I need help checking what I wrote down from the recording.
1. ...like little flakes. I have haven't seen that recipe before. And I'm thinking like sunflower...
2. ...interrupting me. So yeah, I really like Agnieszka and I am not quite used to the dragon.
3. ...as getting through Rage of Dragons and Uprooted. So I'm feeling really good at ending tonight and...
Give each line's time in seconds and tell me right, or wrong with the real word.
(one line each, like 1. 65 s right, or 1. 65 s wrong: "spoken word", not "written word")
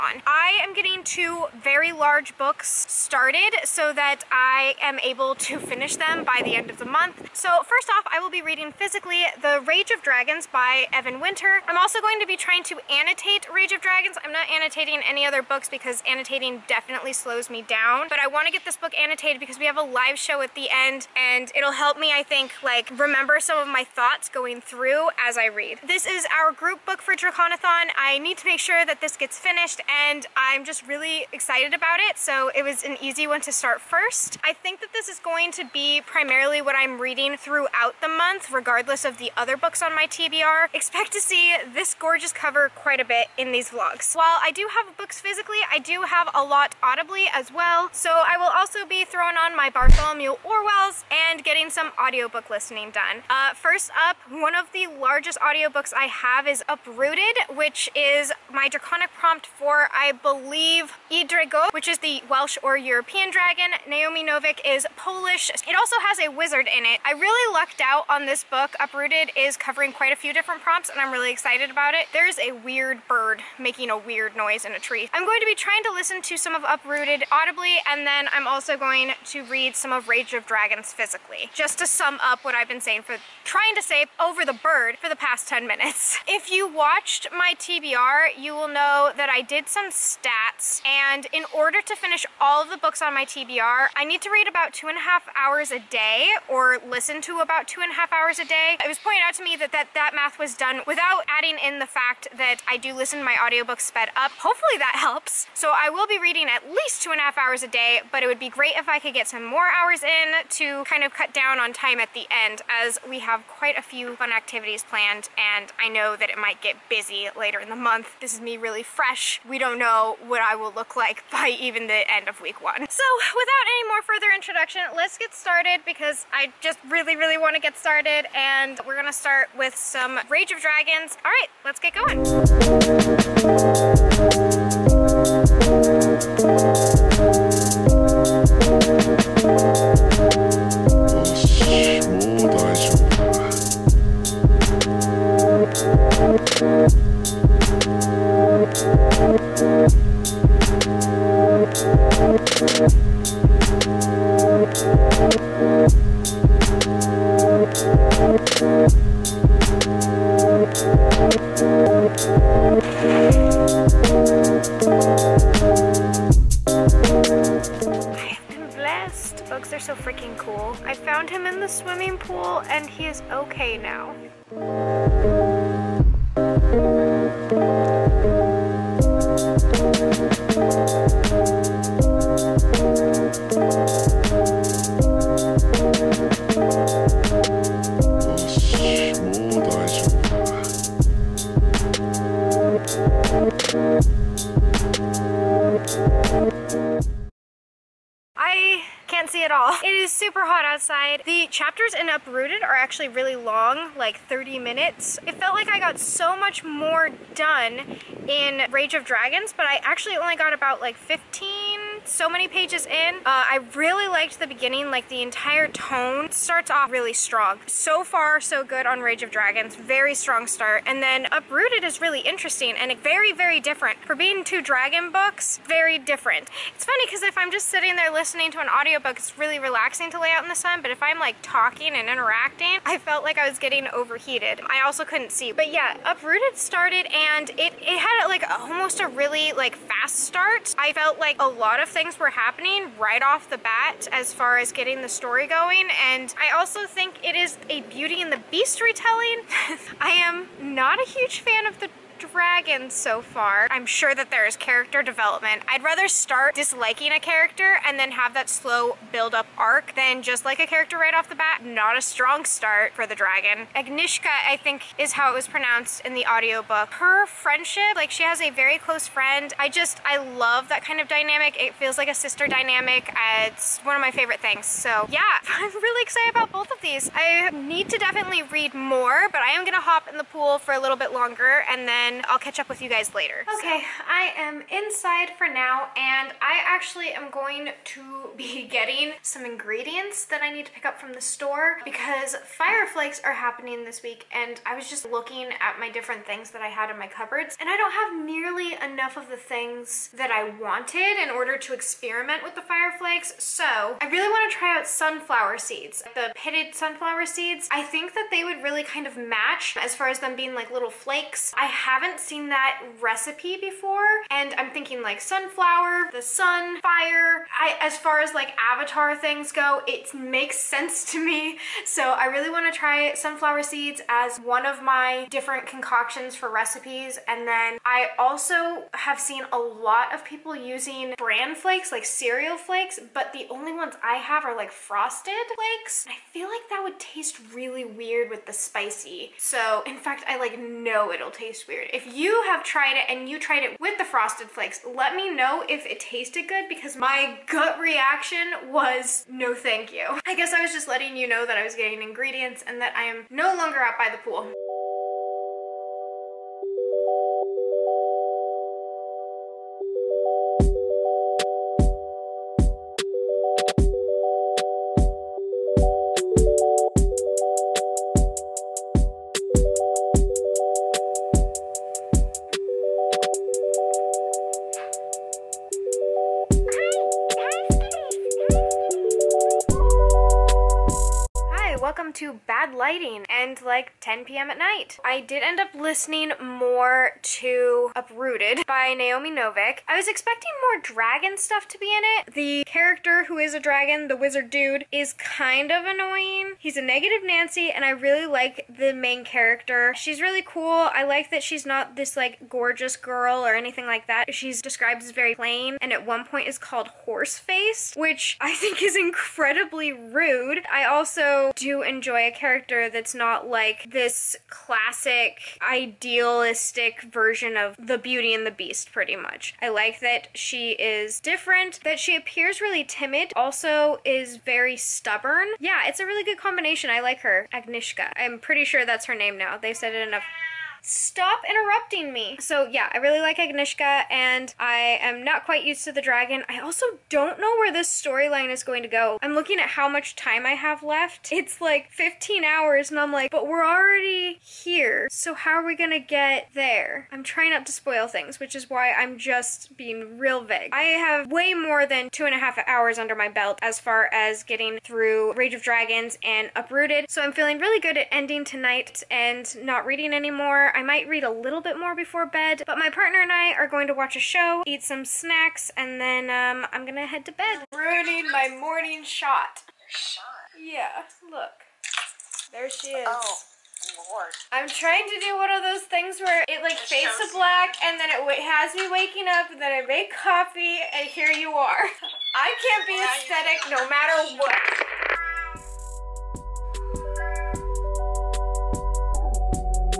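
1. 310 s right
2. 431 s right
3. 454 s right.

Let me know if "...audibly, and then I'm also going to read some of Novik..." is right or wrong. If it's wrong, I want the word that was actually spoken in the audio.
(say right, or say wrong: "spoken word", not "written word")
wrong: "Rage", not "Novik".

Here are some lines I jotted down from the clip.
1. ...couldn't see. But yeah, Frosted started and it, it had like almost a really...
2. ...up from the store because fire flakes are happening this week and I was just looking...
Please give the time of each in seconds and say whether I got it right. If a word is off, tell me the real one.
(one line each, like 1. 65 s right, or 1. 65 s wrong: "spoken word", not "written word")
1. 235 s wrong: "Uprooted", not "Frosted"
2. 290 s right.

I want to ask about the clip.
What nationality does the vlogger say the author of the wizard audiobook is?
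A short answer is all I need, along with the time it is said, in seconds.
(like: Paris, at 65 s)
Polish, at 64 s.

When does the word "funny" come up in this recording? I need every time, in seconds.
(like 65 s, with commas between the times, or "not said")
226 s.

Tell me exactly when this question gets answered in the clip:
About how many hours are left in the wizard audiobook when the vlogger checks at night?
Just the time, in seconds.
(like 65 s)
441 s.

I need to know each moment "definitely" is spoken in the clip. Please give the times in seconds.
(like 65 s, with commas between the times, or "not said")
16 s, 277 s.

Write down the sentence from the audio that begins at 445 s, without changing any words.
So how are we gonna get there?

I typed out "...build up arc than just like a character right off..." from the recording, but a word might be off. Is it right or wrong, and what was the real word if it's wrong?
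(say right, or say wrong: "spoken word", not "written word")
right.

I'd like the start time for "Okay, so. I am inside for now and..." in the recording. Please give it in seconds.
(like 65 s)
283 s.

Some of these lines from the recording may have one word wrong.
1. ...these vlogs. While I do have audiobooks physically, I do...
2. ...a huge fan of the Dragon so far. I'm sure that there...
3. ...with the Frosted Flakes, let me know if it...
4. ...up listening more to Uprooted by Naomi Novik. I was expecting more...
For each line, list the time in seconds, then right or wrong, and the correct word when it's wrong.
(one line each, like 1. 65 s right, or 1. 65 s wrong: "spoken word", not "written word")
1. 43 s wrong: "books", not "audiobooks"
2. 251 s right
3. 343 s right
4. 385 s right.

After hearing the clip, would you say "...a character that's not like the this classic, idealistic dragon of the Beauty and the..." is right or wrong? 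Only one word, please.
wrong.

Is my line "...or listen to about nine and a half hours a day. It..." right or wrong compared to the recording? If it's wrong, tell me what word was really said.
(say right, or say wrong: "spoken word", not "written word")
wrong: "two", not "nine".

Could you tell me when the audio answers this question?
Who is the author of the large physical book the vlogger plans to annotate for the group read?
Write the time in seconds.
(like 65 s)
10 s.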